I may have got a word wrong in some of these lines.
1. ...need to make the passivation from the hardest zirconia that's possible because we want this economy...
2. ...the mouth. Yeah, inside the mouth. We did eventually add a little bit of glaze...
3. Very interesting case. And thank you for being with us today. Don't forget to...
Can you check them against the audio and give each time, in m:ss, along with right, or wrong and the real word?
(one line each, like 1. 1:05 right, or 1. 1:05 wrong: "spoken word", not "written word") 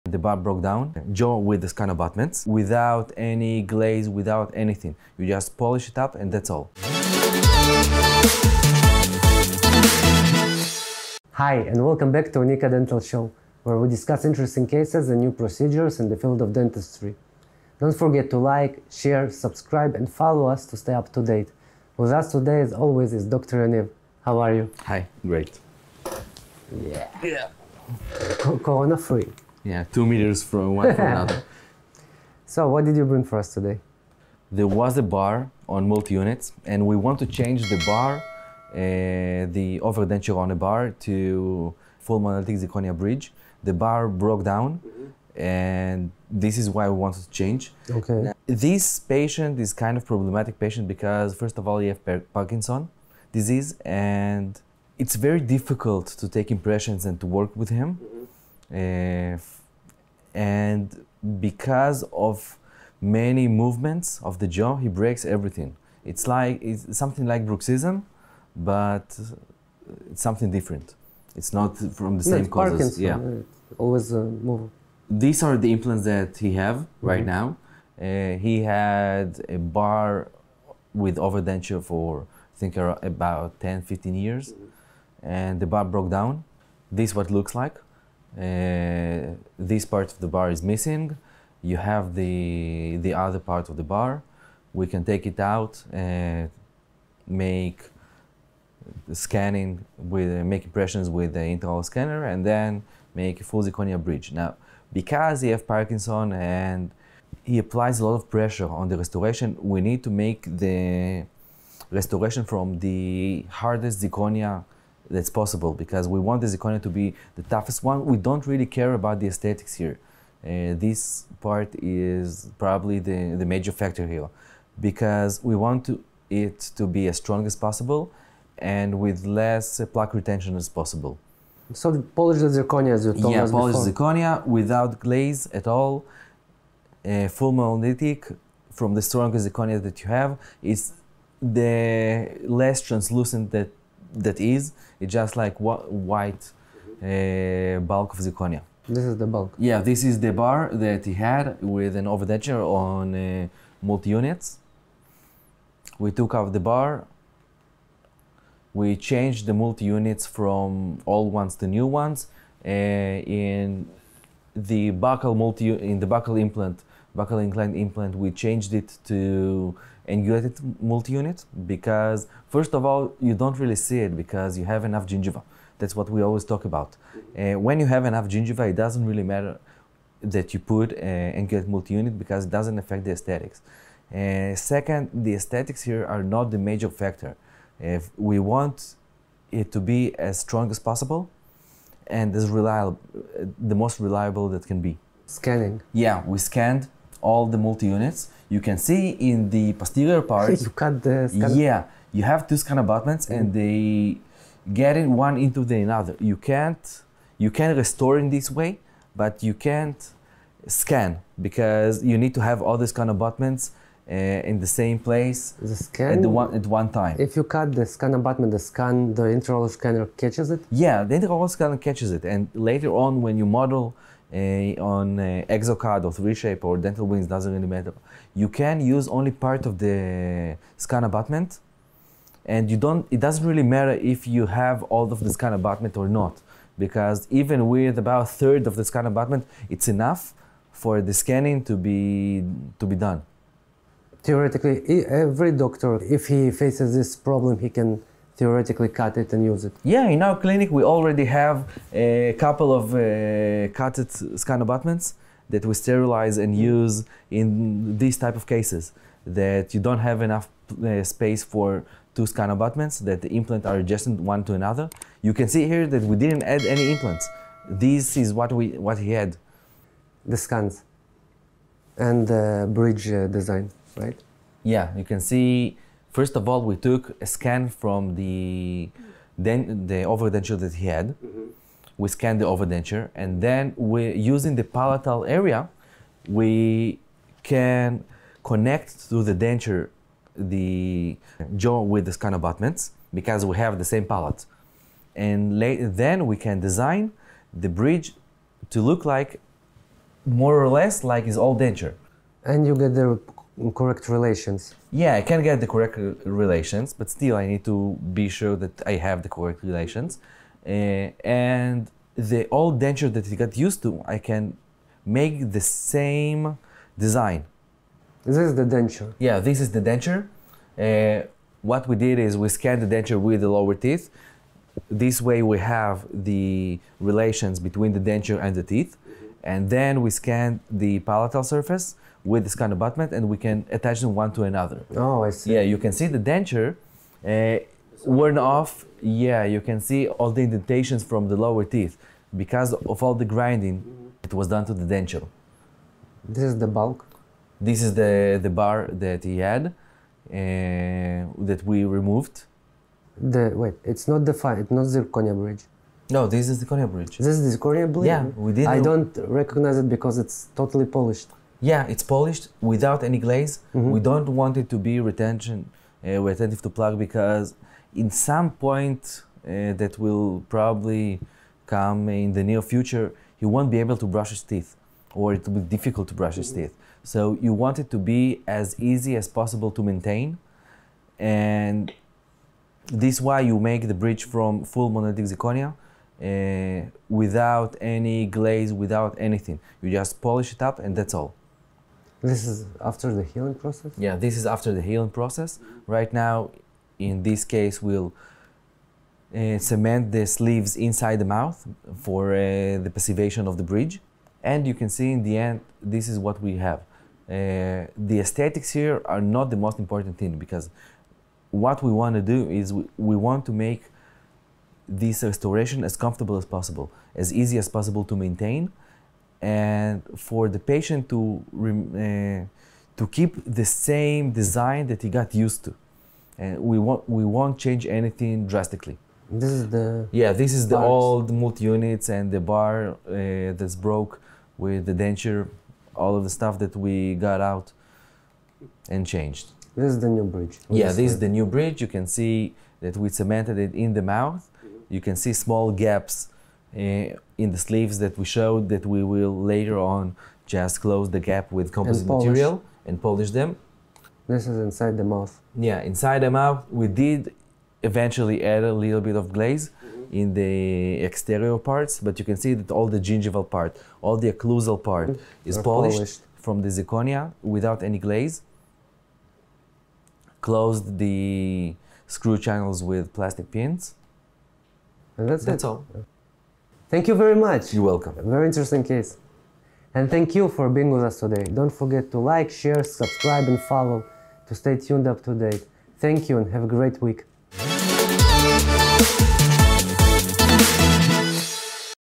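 1. 1:49 wrong: "restoration", not "passivation"
2. 7:34 right
3. 7:58 right.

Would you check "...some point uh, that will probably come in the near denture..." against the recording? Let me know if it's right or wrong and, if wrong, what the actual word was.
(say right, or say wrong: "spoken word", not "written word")
wrong: "future", not "denture".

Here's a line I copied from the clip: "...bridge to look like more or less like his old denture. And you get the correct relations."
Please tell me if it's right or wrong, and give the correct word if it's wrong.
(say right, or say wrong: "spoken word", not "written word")
right.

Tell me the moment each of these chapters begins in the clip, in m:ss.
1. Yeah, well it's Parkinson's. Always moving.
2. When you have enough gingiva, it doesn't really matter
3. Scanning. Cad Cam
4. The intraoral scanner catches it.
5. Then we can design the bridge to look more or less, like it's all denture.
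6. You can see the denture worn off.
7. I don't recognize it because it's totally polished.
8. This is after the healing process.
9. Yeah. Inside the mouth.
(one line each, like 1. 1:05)
1. 1:12
2. 2:29
3. 3:15
4. 3:41
5. 4:34
6. 5:35
7. 5:58
8. 6:32
9. 7:35.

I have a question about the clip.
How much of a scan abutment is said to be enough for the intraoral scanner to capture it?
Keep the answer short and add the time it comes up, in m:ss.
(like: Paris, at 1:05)
about a third, at 3:57.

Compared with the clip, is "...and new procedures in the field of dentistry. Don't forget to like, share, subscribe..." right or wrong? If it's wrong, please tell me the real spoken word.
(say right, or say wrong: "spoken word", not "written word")
right.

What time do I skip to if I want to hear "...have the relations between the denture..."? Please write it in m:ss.
5:25.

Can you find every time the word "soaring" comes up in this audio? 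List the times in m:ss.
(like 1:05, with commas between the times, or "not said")
not said.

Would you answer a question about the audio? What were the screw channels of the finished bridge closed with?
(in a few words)
plastic pins.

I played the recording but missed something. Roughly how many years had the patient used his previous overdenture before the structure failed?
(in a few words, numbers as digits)
10, 15 years.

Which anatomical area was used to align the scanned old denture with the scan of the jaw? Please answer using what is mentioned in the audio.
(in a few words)
palatal area.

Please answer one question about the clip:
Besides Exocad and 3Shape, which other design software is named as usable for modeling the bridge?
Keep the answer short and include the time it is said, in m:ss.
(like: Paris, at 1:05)
Dental Wings, at 3:46.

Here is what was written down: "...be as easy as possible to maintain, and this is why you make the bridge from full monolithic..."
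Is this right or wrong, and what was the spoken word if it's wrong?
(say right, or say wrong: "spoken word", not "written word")
right.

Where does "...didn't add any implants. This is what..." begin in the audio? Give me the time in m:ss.
4:26.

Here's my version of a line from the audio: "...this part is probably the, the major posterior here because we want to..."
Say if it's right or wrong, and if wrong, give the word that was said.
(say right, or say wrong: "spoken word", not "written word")
wrong: "factor", not "posterior".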